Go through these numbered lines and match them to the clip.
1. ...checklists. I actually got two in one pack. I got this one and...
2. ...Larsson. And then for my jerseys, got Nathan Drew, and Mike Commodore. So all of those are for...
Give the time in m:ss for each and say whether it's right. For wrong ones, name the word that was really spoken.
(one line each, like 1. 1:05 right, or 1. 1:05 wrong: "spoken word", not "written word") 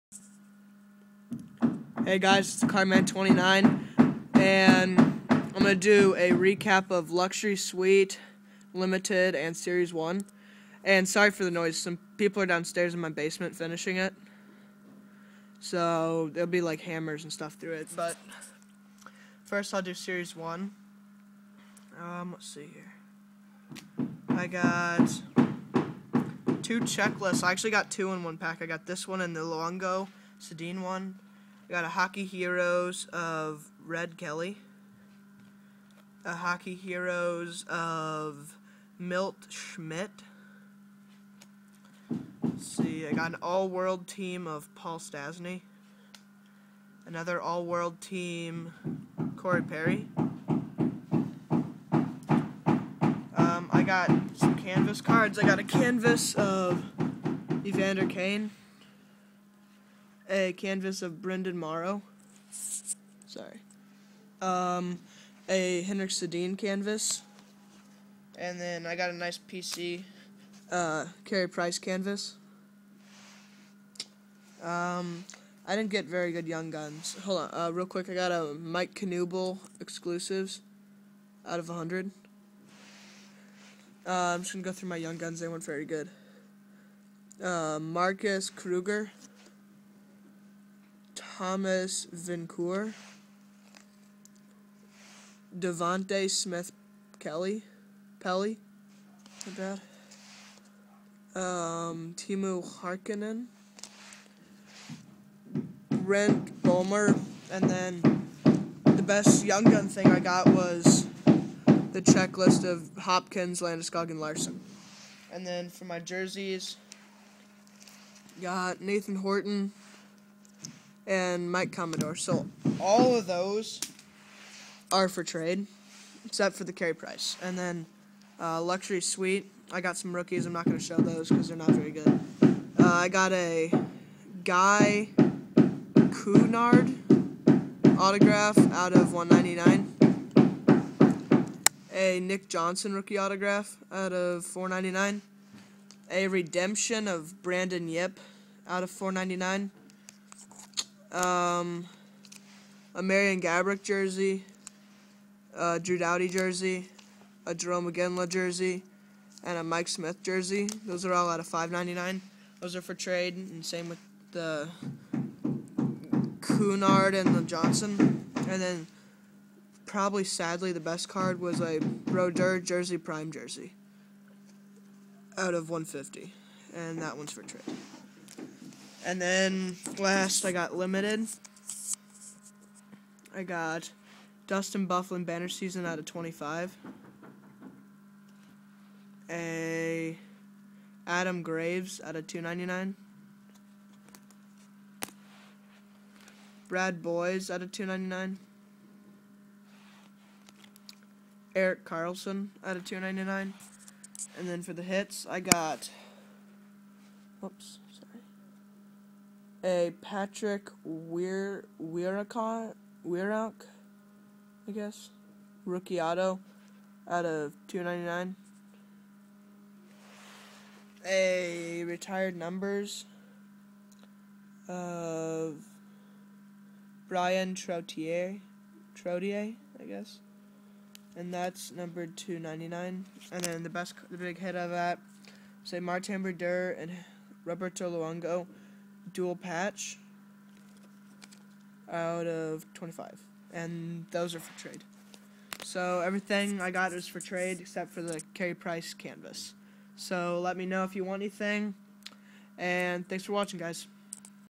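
1. 0:26 right
2. 1:54 wrong: "Horton", not "Drew".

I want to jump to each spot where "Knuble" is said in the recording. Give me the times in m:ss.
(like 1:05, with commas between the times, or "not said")
1:18.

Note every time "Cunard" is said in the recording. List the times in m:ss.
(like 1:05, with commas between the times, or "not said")
2:16, 2:46.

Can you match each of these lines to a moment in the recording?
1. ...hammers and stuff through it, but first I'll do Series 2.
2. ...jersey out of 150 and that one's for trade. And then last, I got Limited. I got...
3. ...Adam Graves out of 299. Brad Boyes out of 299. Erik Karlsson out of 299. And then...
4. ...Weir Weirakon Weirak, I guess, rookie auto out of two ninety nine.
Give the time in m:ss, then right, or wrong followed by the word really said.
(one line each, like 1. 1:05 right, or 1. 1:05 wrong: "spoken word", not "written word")
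1. 0:16 wrong: "1", not "2"
2. 2:53 right
3. 3:11 right
4. 3:30 right.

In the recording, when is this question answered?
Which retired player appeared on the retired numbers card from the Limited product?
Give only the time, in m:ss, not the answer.
3:47.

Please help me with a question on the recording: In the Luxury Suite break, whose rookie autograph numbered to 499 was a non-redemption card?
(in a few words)
Nick Johnson.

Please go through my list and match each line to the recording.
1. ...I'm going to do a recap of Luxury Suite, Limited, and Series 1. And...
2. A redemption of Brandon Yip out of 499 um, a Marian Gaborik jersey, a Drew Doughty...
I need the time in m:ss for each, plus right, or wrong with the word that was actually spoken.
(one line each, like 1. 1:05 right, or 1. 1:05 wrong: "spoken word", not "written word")
1. 0:05 right
2. 2:26 right.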